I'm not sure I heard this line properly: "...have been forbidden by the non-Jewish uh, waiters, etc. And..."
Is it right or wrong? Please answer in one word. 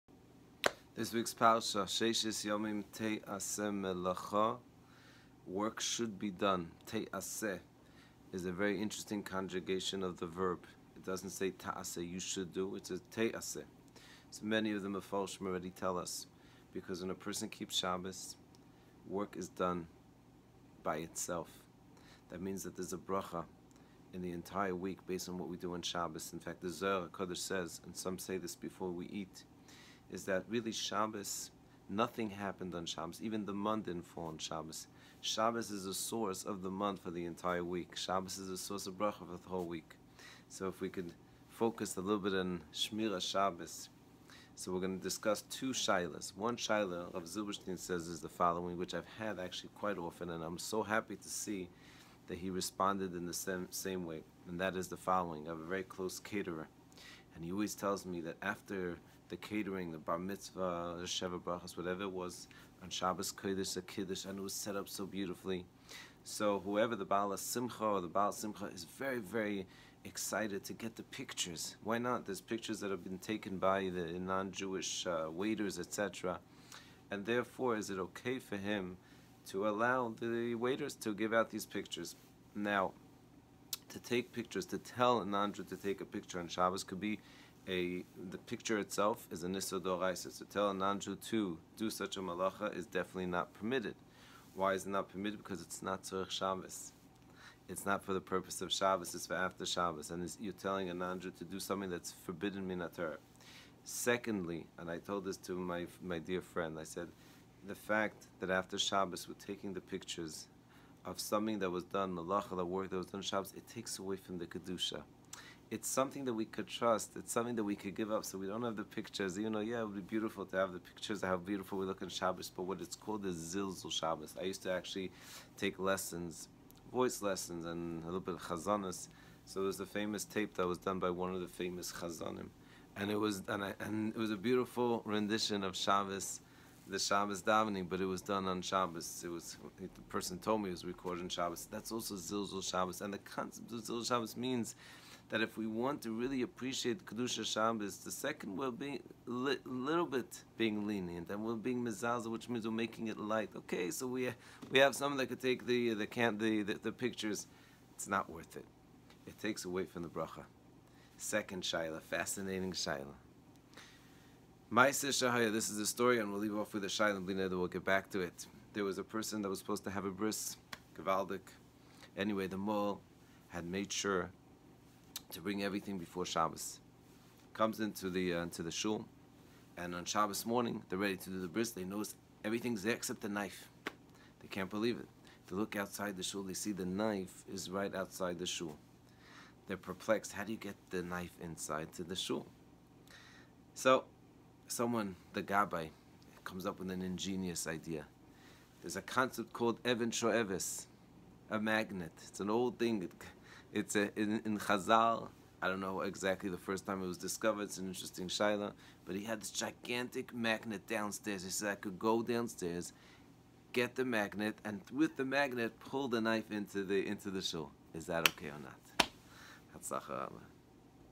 wrong.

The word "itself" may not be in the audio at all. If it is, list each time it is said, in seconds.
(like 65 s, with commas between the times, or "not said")
20 s, 88 s.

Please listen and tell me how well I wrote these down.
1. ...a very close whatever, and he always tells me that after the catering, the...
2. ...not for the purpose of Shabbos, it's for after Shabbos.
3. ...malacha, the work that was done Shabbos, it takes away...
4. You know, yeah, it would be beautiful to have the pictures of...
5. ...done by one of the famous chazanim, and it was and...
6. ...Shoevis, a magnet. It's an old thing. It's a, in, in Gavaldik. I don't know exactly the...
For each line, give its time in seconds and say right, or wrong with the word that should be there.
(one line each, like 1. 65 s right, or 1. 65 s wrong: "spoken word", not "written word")
1. 55 s wrong: "caterer", not "whatever"
2. 97 s right
3. 112 s right
4. 119 s right
5. 130 s right
6. 200 s wrong: "Chazal", not "Gavaldik".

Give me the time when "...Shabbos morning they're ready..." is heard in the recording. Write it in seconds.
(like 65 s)
180 s.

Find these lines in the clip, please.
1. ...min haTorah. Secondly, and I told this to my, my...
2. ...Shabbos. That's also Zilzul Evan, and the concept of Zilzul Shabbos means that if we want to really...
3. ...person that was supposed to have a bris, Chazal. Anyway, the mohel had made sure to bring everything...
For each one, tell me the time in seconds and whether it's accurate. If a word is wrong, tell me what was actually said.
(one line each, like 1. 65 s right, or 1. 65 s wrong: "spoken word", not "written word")
1. 102 s right
2. 141 s wrong: "Shabbos", not "Evan"
3. 169 s wrong: "Gavaldik", not "Chazal".